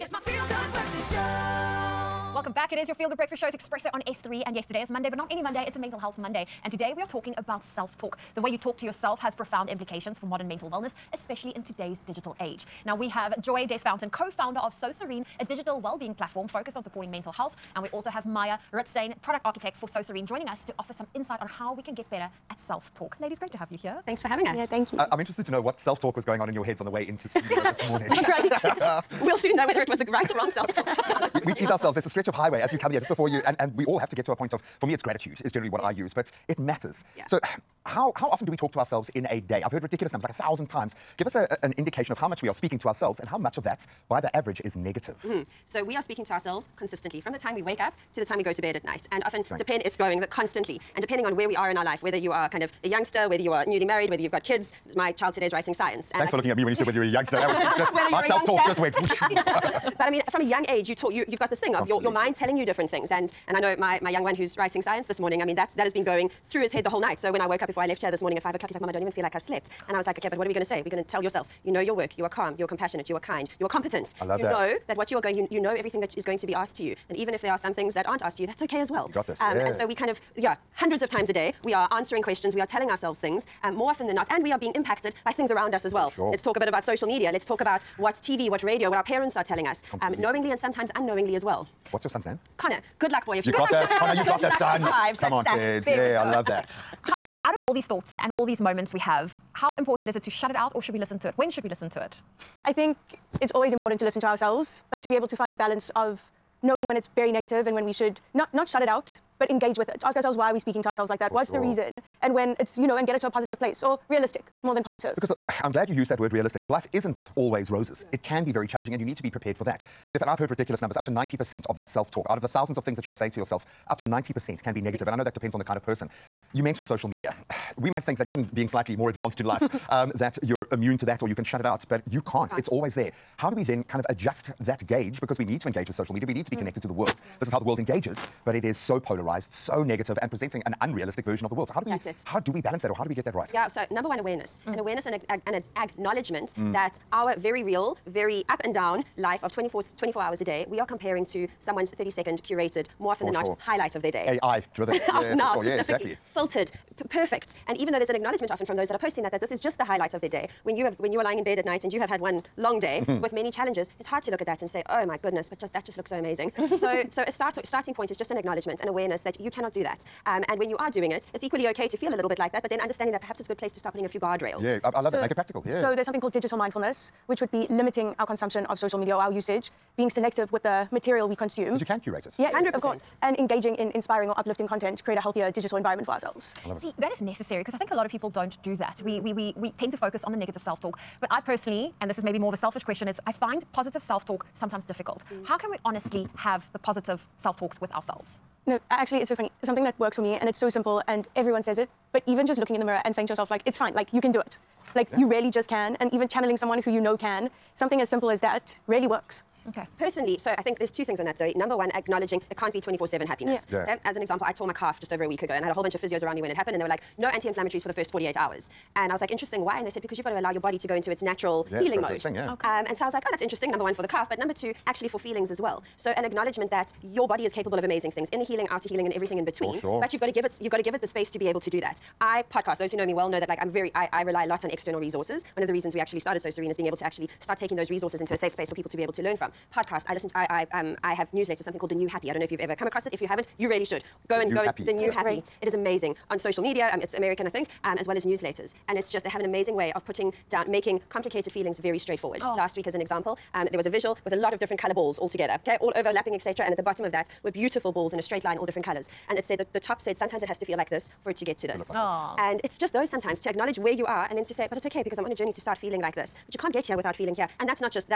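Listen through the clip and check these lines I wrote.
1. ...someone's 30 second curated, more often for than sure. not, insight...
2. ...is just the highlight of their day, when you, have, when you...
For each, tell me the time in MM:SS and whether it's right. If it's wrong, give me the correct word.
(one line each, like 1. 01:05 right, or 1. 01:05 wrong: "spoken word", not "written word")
1. 02:31 wrong: "highlight", not "insight"
2. 02:39 right.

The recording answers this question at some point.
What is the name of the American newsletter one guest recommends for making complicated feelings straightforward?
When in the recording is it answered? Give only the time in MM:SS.
04:01.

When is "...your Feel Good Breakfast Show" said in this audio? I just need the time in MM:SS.
00:02.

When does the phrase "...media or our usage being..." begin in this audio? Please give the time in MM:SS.
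02:58.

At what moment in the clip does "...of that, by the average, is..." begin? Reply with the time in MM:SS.
00:43.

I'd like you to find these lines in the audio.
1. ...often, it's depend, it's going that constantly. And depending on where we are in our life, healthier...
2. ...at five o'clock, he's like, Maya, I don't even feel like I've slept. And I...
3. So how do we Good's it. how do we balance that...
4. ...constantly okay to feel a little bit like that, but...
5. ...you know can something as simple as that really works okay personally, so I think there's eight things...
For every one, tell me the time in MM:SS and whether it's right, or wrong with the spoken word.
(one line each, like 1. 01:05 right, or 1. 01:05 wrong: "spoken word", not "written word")
1. 00:49 wrong: "whether", not "healthier"
2. 01:08 wrong: "Mom", not "Maya"
3. 02:21 wrong: "That", not "Good"
4. 02:51 wrong: "equally", not "constantly"
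5. 03:26 wrong: "two", not "eight".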